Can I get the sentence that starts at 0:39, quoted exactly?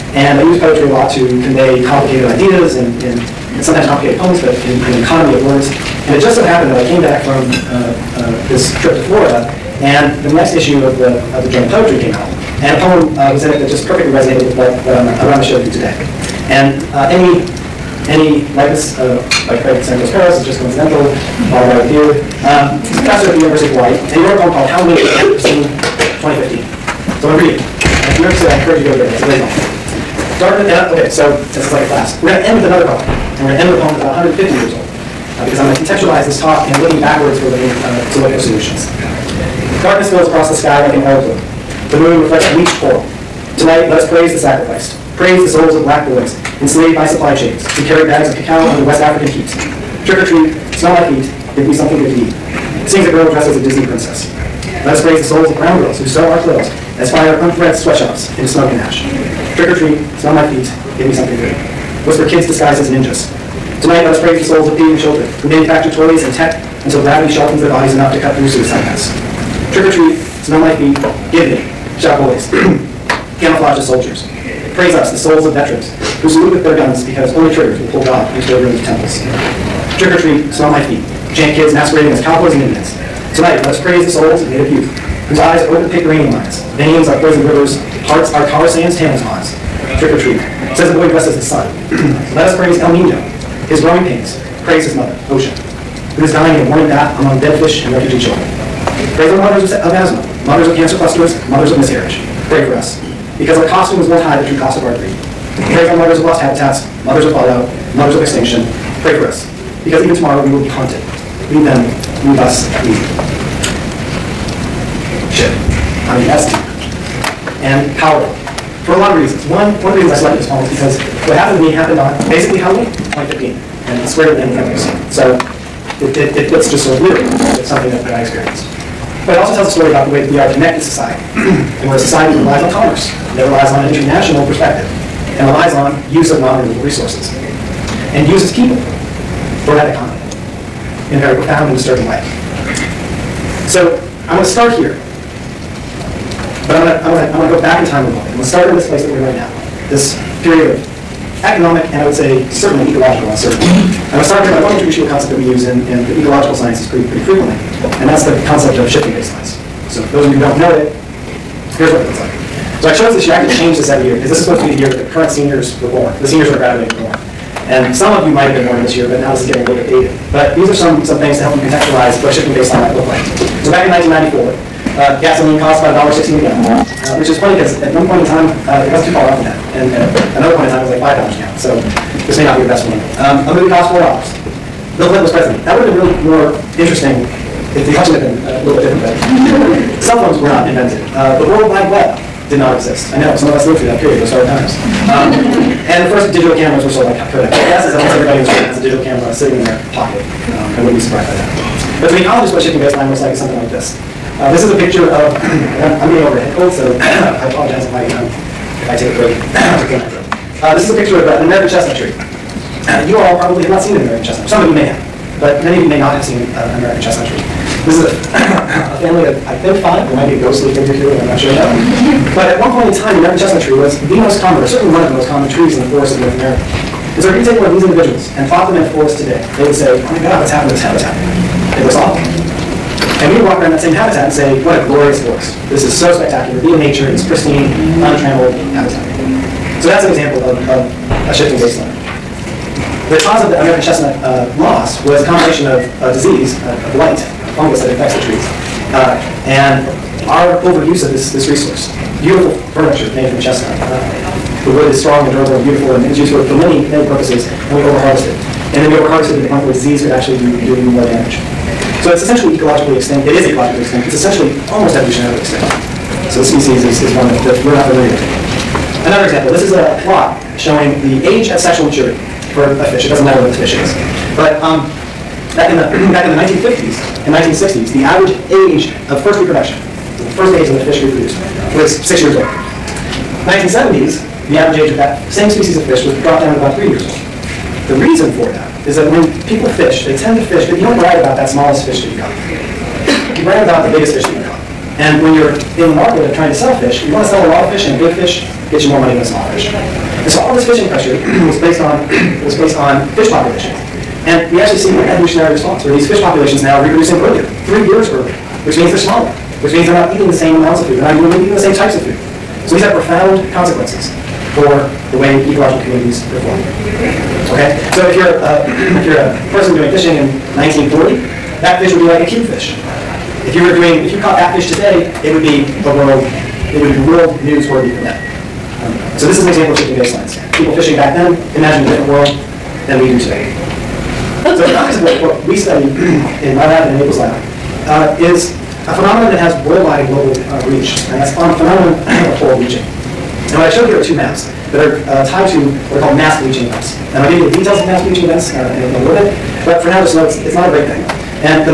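Darkness spills across the sky like an oil The moon reflects bleached coral.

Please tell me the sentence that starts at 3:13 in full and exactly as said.
I know, some of us lived through that period, those hard times.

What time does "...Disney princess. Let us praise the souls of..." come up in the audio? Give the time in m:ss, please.
0:53.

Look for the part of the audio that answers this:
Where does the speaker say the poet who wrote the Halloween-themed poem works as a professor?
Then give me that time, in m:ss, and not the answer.
0:23.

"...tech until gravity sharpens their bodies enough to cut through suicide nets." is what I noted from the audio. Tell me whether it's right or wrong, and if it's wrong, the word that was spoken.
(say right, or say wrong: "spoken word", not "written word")
right.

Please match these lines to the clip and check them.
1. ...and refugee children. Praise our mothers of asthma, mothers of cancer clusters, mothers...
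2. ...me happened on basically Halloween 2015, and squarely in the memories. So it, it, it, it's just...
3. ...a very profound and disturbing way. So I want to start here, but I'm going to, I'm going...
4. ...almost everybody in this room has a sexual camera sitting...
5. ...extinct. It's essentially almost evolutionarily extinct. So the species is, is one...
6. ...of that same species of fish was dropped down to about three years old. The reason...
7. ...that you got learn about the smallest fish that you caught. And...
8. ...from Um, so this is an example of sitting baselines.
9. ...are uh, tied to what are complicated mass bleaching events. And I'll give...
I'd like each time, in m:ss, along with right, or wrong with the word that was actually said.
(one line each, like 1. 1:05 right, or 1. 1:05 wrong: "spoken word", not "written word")
1. 1:37 right
2. 2:01 right
3. 2:21 right
4. 3:17 wrong: "digital", not "sexual"
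5. 4:23 right
6. 4:44 right
7. 4:52 wrong: "biggest", not "smallest"
8. 5:27 wrong: "shifting", not "sitting"
9. 5:44 wrong: "called", not "complicated".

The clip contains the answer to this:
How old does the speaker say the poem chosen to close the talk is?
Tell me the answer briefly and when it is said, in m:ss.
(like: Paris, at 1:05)
about 150 years, at 0:34.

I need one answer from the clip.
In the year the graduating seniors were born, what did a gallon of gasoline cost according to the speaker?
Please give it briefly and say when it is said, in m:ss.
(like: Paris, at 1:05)
$1.60, at 2:56.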